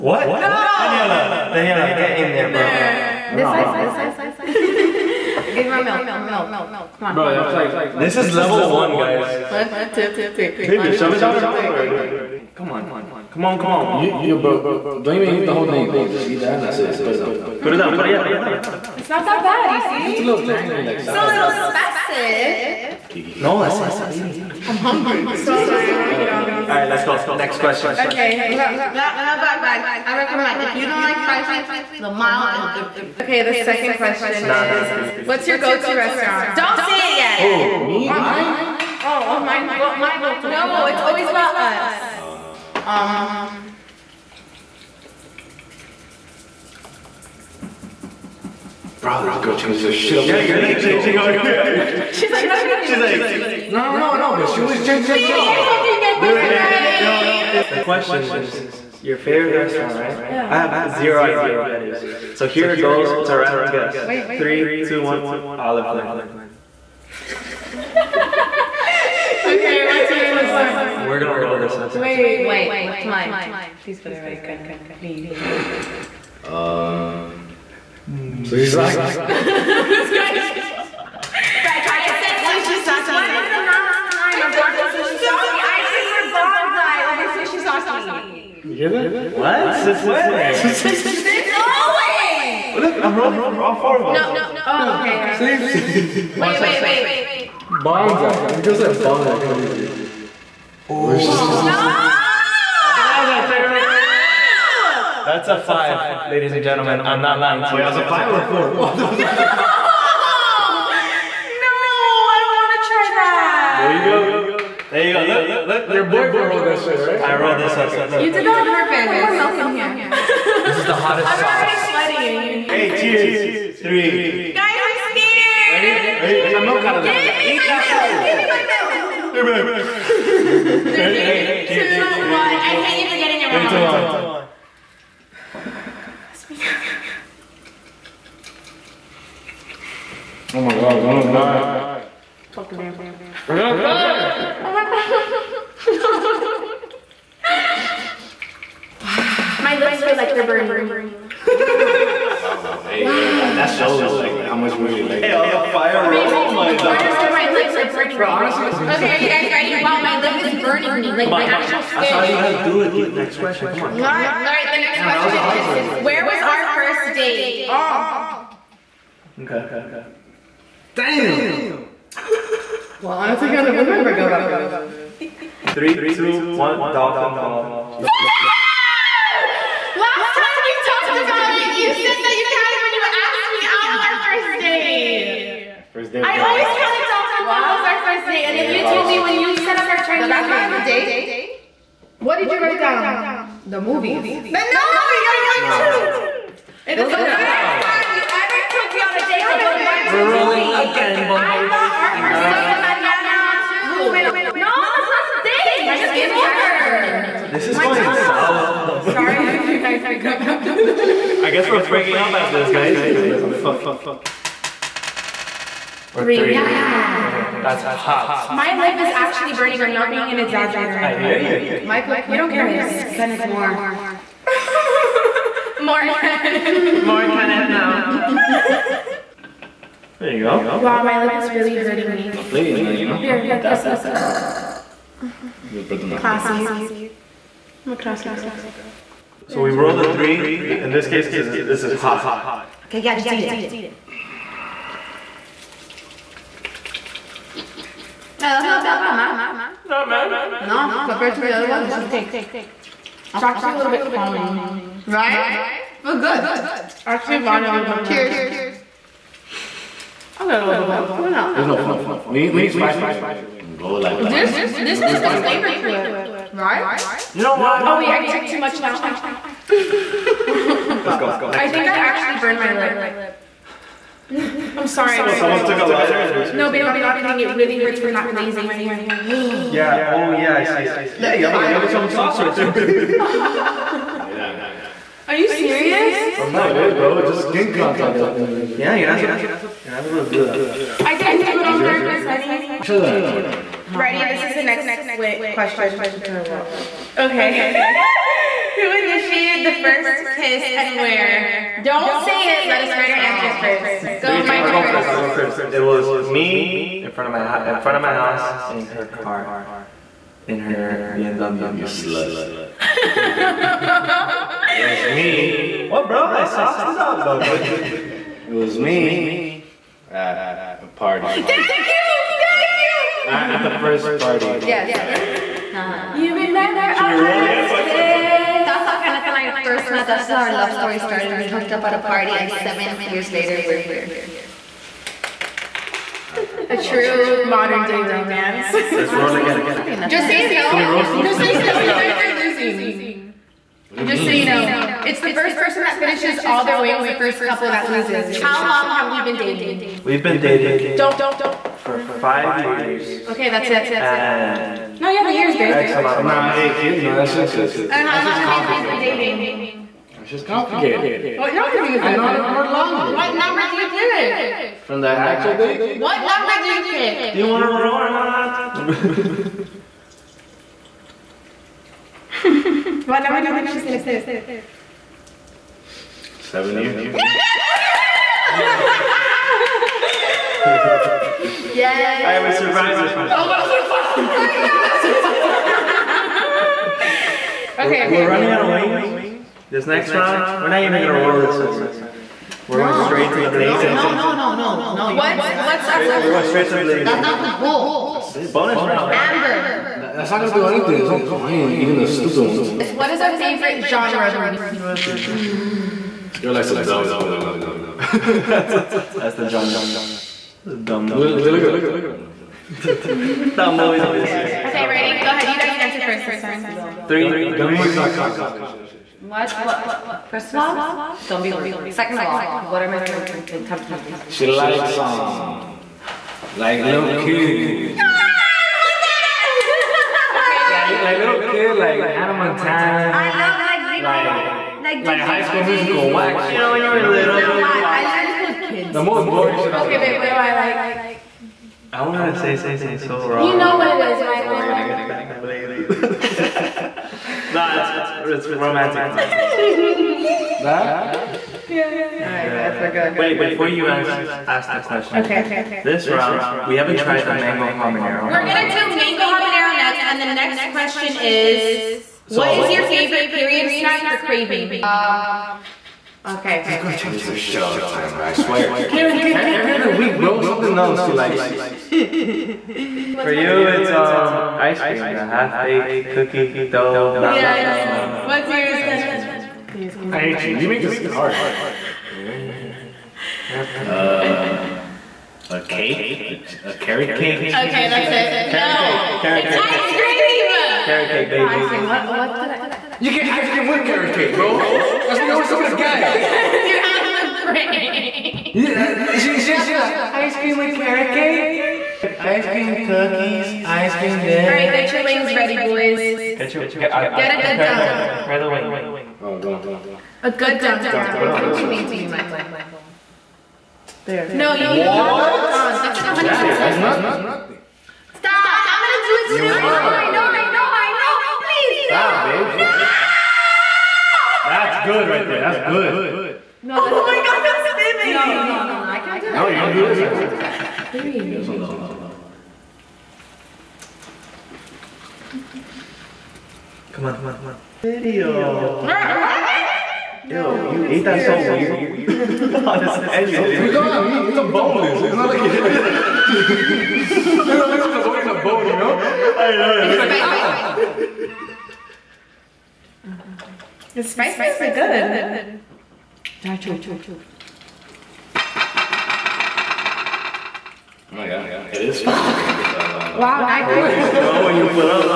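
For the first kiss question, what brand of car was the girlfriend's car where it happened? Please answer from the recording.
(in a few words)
BMW.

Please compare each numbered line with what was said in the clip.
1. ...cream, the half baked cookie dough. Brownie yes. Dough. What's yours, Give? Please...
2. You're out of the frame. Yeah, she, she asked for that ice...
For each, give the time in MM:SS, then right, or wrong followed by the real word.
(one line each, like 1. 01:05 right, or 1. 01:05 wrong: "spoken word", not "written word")
1. 07:54 wrong: "Kenna", not "Give"
2. 08:16 right.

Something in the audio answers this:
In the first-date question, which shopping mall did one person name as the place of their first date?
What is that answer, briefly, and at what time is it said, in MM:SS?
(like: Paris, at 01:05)
Dolphin Mall, at 02:56.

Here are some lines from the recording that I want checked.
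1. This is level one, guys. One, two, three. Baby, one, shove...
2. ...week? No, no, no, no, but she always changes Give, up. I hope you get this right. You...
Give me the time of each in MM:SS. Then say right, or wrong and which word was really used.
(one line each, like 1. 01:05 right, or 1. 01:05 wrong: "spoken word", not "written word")
1. 00:07 right
2. 00:53 wrong: "Baby", not "Give".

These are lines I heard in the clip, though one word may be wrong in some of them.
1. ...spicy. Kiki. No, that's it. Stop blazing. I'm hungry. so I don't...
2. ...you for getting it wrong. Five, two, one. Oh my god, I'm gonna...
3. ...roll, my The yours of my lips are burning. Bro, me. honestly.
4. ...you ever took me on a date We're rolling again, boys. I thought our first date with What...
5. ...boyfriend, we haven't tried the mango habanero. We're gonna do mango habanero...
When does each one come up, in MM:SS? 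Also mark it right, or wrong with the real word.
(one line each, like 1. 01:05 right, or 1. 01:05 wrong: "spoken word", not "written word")
1. 00:21 wrong: "eating", not "blazing"
2. 02:13 wrong: "Three", not "Five"
3. 02:36 wrong: "corners", not "yours"
4. 03:18 wrong: "Mariana", not "What"
5. 07:36 wrong: "round", not "boyfriend".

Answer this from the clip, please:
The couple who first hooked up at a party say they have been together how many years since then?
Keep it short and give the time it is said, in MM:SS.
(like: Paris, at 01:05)
7, at 05:32.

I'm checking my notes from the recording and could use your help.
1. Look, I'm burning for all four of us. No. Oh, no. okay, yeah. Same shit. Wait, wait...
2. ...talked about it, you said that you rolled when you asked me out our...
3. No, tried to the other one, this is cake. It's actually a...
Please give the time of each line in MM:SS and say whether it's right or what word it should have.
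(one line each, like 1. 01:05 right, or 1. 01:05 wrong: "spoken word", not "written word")
1. 01:32 wrong: "rolling", not "burning"
2. 03:00 wrong: "counted", not "rolled"
3. 04:10 wrong: "compared", not "tried".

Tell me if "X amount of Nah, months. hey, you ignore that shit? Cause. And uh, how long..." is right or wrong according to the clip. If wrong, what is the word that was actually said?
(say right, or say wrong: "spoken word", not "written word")
right.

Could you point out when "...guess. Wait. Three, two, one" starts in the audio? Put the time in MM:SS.
01:03.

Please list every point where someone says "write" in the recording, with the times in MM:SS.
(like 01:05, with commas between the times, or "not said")
03:12, 05:02.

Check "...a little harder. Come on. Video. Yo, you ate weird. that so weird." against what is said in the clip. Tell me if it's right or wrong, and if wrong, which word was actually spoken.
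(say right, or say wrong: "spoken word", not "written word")
right.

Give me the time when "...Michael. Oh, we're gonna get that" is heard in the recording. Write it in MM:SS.
07:24.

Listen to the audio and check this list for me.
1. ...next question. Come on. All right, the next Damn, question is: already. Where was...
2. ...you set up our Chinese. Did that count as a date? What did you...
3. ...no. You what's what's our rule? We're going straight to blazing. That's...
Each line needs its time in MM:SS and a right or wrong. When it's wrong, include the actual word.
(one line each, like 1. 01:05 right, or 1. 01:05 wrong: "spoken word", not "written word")
1. 02:43 right
2. 03:09 right
3. 06:34 right.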